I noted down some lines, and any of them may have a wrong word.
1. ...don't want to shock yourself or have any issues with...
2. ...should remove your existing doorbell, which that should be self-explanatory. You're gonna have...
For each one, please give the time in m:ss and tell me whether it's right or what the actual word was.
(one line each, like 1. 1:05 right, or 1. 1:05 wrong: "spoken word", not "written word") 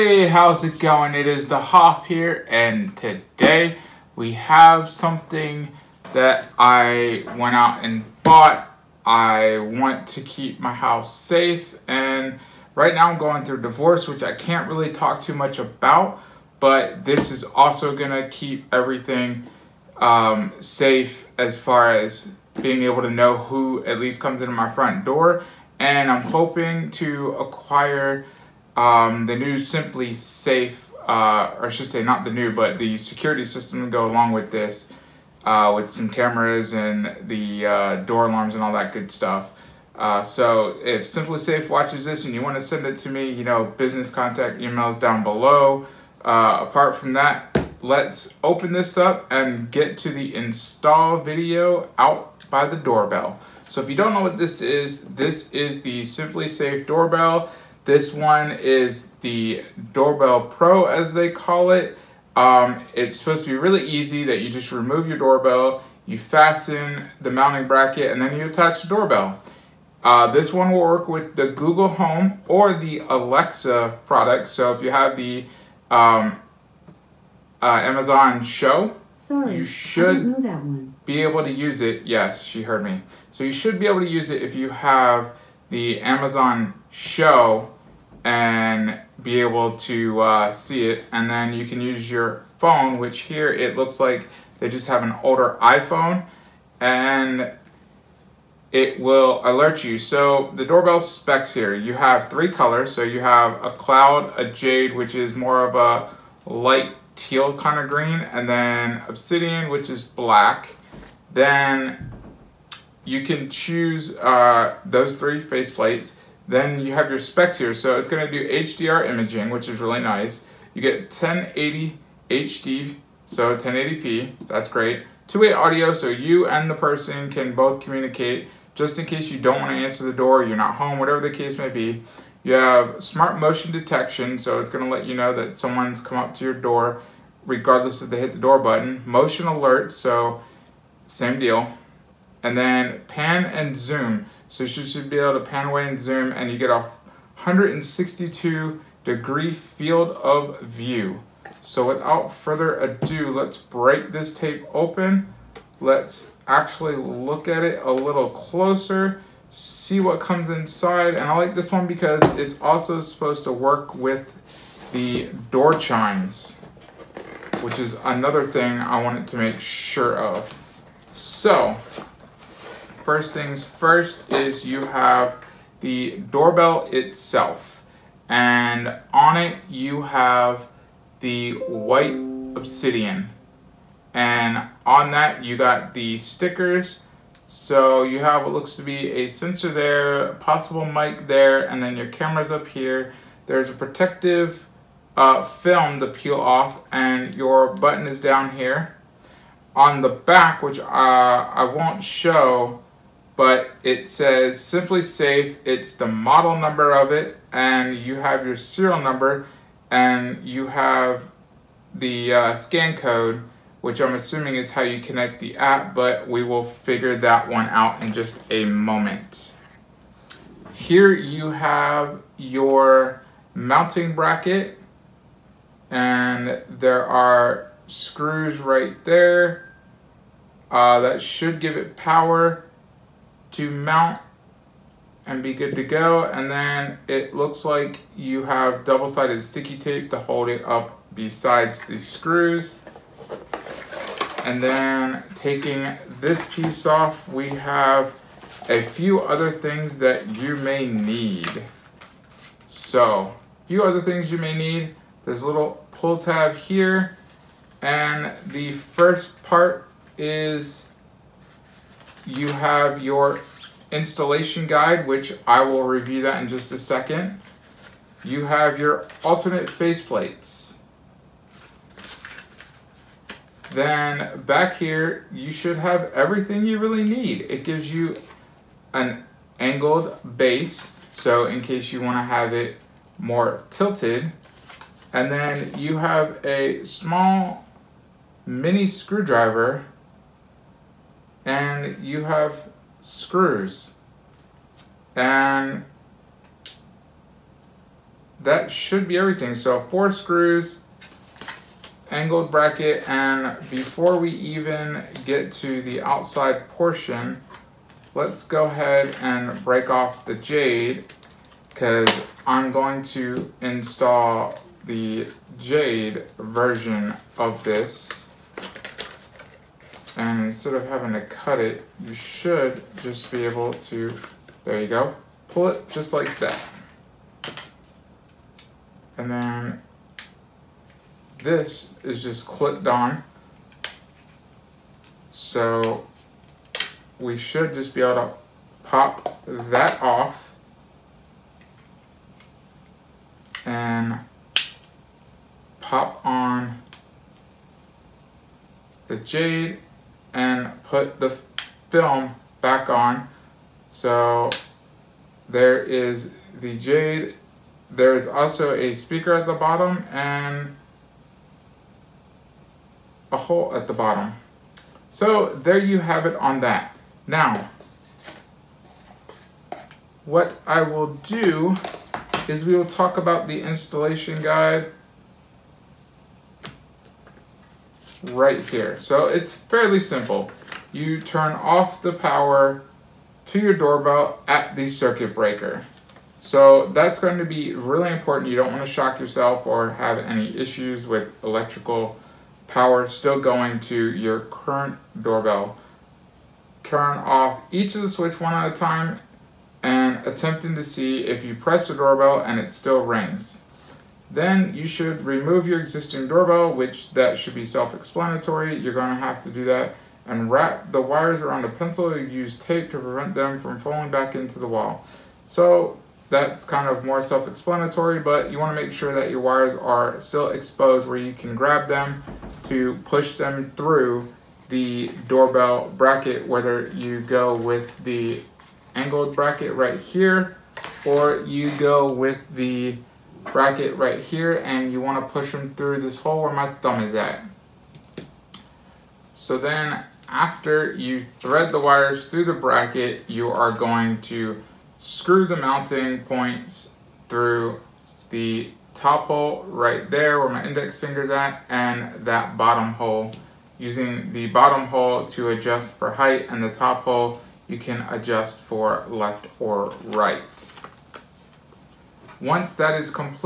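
1. 6:28 right
2. 6:44 right.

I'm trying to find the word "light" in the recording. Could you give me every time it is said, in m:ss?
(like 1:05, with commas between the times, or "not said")
1:46.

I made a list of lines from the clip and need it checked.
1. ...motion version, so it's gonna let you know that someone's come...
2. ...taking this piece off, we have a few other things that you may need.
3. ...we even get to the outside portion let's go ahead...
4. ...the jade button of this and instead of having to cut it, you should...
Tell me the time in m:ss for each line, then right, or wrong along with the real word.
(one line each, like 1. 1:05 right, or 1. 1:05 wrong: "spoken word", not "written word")
1. 2:13 wrong: "detection", not "version"
2. 4:05 right
3. 5:04 right
4. 5:14 wrong: "version", not "button".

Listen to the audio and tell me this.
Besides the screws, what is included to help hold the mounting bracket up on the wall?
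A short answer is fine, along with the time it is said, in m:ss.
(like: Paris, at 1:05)
Double-sided sticky tape, at 3:58.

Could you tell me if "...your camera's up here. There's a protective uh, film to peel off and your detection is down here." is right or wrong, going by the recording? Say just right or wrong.
wrong.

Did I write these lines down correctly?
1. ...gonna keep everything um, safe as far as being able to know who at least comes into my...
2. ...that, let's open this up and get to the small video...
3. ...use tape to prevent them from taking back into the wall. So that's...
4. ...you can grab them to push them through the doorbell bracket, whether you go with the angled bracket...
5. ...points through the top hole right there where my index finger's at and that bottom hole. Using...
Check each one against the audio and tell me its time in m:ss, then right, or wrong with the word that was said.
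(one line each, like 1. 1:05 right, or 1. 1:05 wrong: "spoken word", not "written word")
1. 0:17 right
2. 0:47 wrong: "install", not "small"
3. 6:52 wrong: "falling", not "taking"
4. 7:01 right
5. 7:26 right.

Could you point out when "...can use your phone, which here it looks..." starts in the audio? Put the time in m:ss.
1:31.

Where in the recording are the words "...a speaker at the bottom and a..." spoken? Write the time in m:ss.
5:58.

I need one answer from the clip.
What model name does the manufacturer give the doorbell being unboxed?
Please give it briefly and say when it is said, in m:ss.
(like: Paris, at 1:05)
Doorbell Pro, at 0:59.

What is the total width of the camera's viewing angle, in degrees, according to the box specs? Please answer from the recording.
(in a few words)
162 degrees.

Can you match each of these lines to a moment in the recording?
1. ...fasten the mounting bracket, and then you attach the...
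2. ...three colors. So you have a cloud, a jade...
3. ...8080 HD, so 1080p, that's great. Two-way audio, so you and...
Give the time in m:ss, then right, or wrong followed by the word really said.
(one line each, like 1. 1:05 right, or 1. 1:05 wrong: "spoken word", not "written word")
1. 1:06 right
2. 1:42 right
3. 2:01 wrong: "1080", not "8080".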